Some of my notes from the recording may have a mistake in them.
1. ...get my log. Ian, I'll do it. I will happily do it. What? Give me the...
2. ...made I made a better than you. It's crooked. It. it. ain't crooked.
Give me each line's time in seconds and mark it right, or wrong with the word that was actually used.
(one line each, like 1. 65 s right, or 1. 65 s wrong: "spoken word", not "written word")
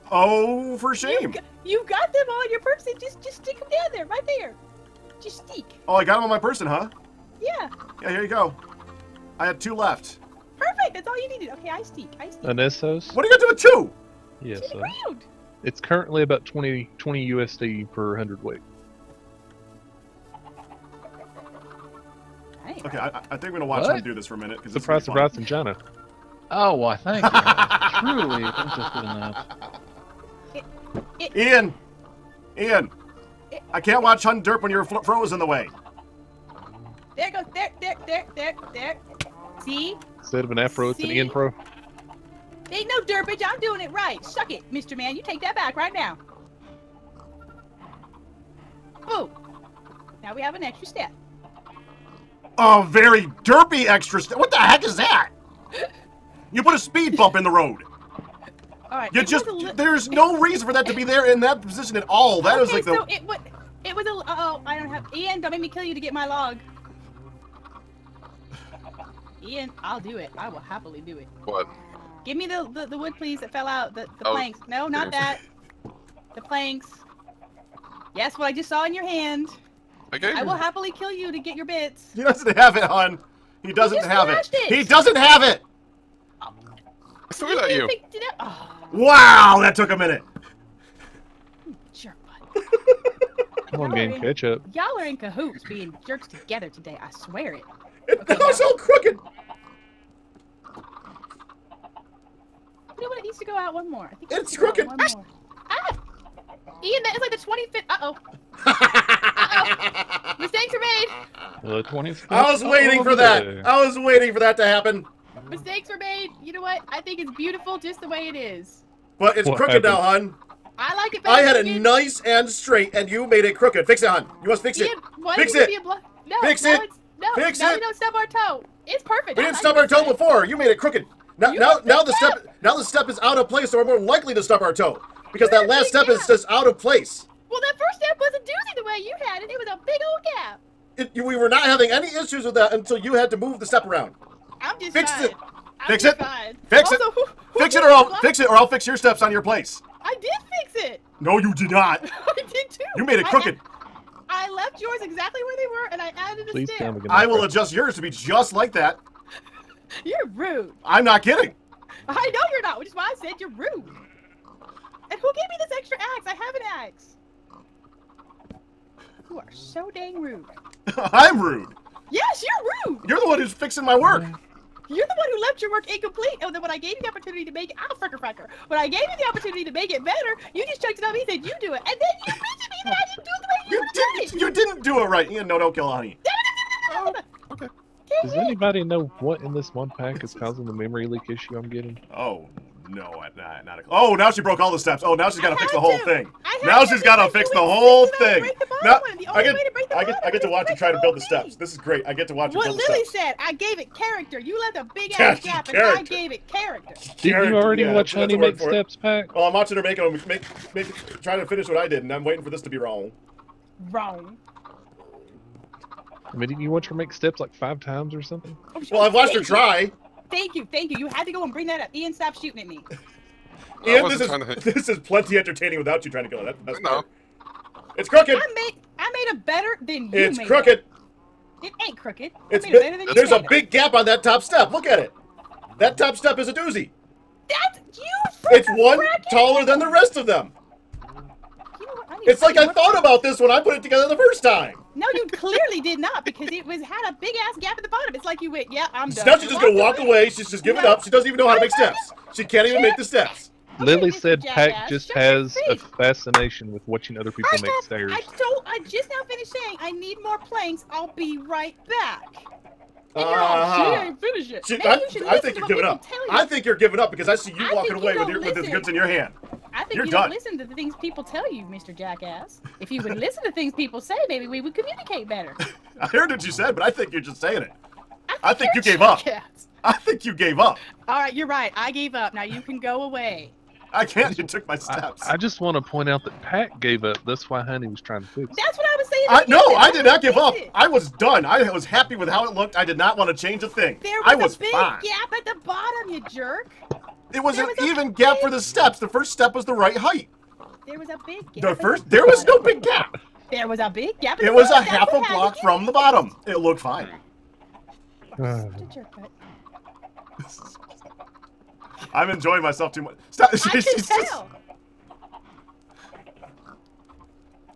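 1. 65 s right
2. 228 s right.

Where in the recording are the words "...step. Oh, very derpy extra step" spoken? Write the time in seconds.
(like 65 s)
50 s.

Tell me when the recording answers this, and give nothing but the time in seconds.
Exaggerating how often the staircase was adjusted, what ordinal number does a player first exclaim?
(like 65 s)
107 s.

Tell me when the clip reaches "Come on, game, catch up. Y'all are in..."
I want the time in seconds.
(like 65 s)
93 s.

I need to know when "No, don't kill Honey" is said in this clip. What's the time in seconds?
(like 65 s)
185 s.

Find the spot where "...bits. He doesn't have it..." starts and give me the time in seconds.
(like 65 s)
81 s.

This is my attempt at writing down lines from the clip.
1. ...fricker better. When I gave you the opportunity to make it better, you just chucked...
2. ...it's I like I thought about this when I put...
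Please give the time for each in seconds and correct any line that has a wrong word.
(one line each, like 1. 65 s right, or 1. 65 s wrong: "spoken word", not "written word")
1. 177 s wrong: "fracker", not "better"
2. 242 s right.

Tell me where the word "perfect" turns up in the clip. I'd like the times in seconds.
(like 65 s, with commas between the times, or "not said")
10 s, 129 s.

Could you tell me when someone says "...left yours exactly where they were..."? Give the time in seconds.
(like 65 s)
154 s.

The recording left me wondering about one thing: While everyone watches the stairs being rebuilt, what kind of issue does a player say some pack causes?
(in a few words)
memory leak.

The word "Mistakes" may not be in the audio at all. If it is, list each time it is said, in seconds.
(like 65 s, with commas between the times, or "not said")
110 s, 115 s.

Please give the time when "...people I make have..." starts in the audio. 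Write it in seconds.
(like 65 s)
257 s.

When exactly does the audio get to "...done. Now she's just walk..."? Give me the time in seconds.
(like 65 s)
249 s.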